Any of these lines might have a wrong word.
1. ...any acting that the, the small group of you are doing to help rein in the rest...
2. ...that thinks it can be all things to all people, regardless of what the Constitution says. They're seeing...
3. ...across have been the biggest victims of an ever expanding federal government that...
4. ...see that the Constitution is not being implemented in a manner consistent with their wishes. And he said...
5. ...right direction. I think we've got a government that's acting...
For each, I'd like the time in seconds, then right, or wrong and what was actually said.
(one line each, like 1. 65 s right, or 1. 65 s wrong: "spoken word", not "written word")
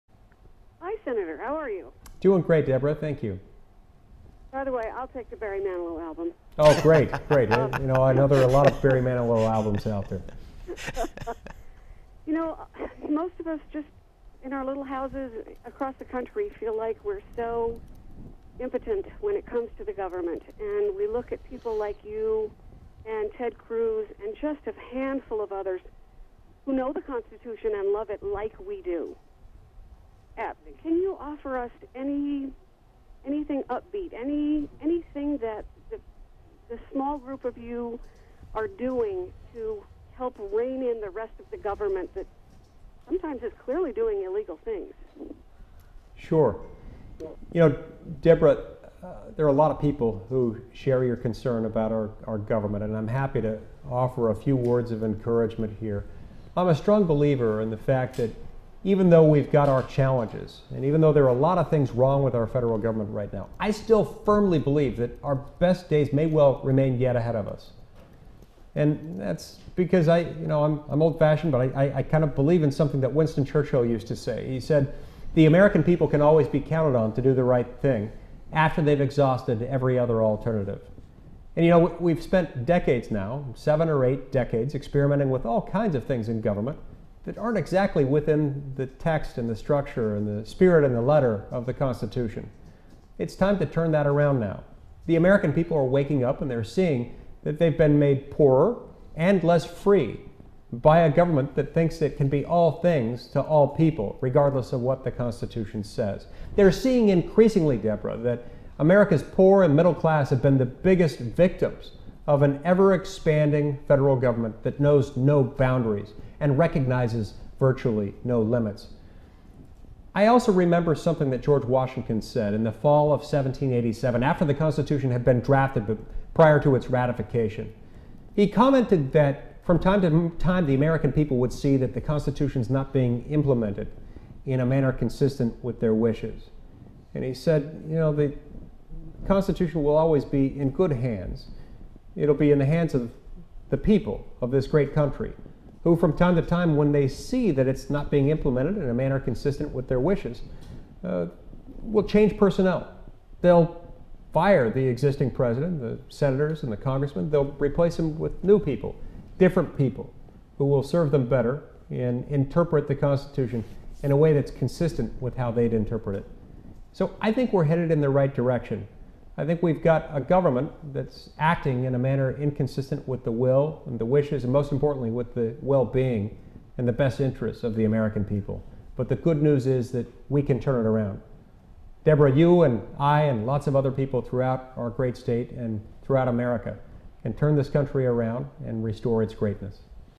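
1. 34 s wrong: "anything", not "acting"
2. 101 s right
3. 109 s wrong: "class", not "across"
4. 131 s right
5. 168 s right.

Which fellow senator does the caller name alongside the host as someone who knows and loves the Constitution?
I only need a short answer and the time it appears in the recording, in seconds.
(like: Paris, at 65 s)
Ted Cruz, at 23 s.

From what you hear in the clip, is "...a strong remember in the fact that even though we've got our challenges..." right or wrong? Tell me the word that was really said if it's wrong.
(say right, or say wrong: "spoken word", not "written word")
wrong: "believer", not "remember".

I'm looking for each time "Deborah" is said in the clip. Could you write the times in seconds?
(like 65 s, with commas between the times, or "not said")
2 s, 48 s, 107 s, 182 s.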